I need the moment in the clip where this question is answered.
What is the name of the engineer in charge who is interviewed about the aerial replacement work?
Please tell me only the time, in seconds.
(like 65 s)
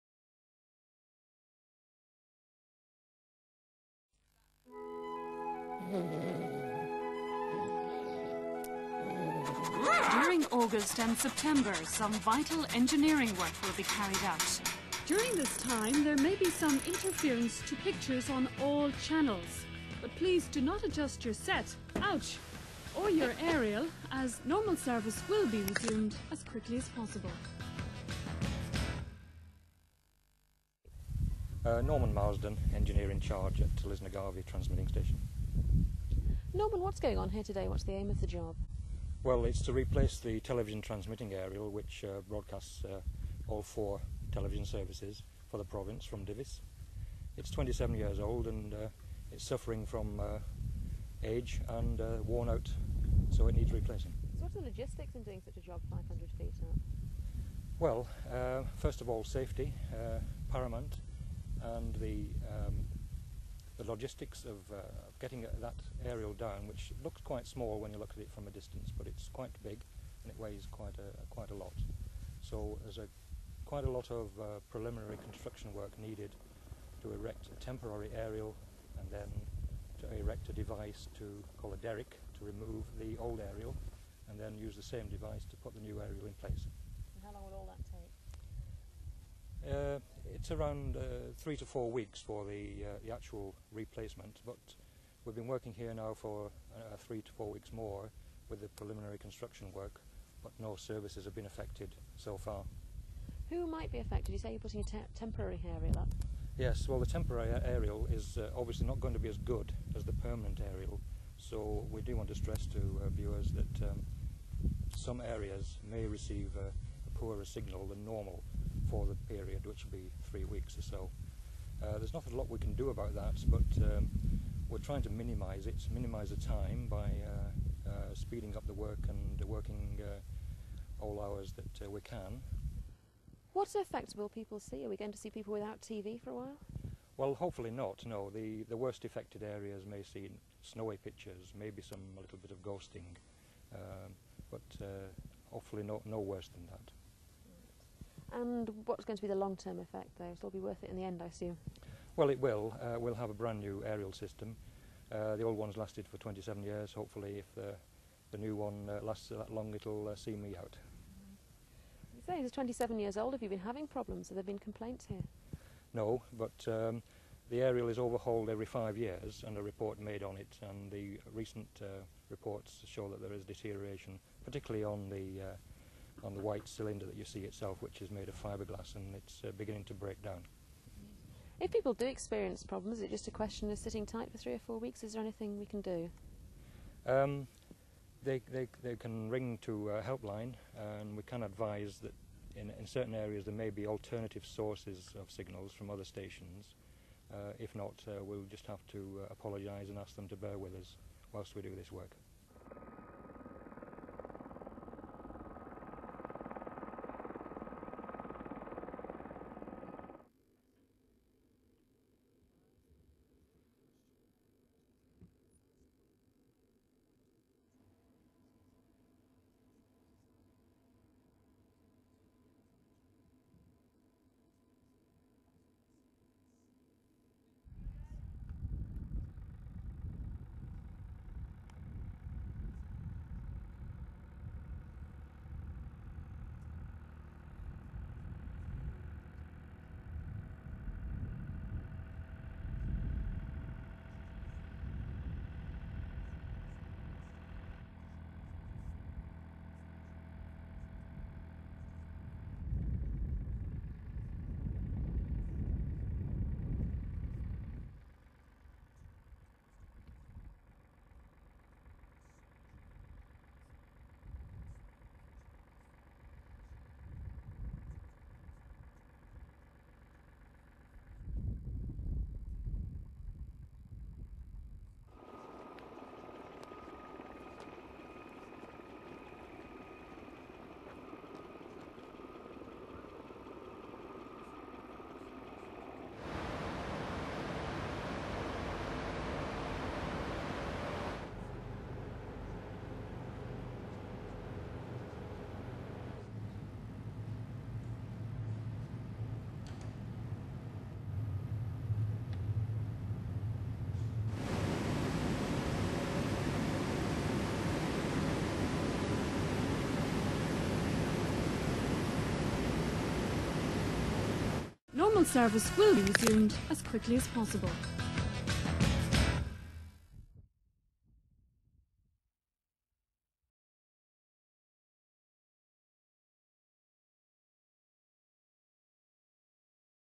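31 s.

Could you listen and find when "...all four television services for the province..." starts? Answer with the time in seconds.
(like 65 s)
43 s.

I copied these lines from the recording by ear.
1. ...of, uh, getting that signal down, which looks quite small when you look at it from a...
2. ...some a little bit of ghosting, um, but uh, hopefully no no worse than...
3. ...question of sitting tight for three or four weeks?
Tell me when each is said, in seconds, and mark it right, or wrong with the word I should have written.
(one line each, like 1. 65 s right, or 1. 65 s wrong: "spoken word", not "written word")
1. 64 s wrong: "aerial", not "signal"
2. 141 s right
3. 183 s right.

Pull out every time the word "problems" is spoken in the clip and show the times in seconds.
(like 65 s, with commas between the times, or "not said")
163 s, 182 s.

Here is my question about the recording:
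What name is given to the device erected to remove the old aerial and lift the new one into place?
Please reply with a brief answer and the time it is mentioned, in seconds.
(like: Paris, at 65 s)
derrick, at 81 s.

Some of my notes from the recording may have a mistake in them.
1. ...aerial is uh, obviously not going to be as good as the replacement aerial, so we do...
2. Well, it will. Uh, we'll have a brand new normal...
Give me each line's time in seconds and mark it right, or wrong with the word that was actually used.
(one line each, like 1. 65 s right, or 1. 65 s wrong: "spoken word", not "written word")
1. 107 s wrong: "permanent", not "replacement"
2. 152 s wrong: "aerial", not "normal".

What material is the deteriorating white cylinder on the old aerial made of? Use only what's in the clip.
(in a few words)
fiberglass.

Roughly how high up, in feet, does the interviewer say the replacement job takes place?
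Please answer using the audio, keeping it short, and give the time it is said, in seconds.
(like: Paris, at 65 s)
500 feet, at 55 s.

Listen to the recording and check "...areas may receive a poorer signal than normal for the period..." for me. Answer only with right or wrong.
right.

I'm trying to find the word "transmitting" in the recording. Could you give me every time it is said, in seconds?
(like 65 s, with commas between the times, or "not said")
34 s, 40 s.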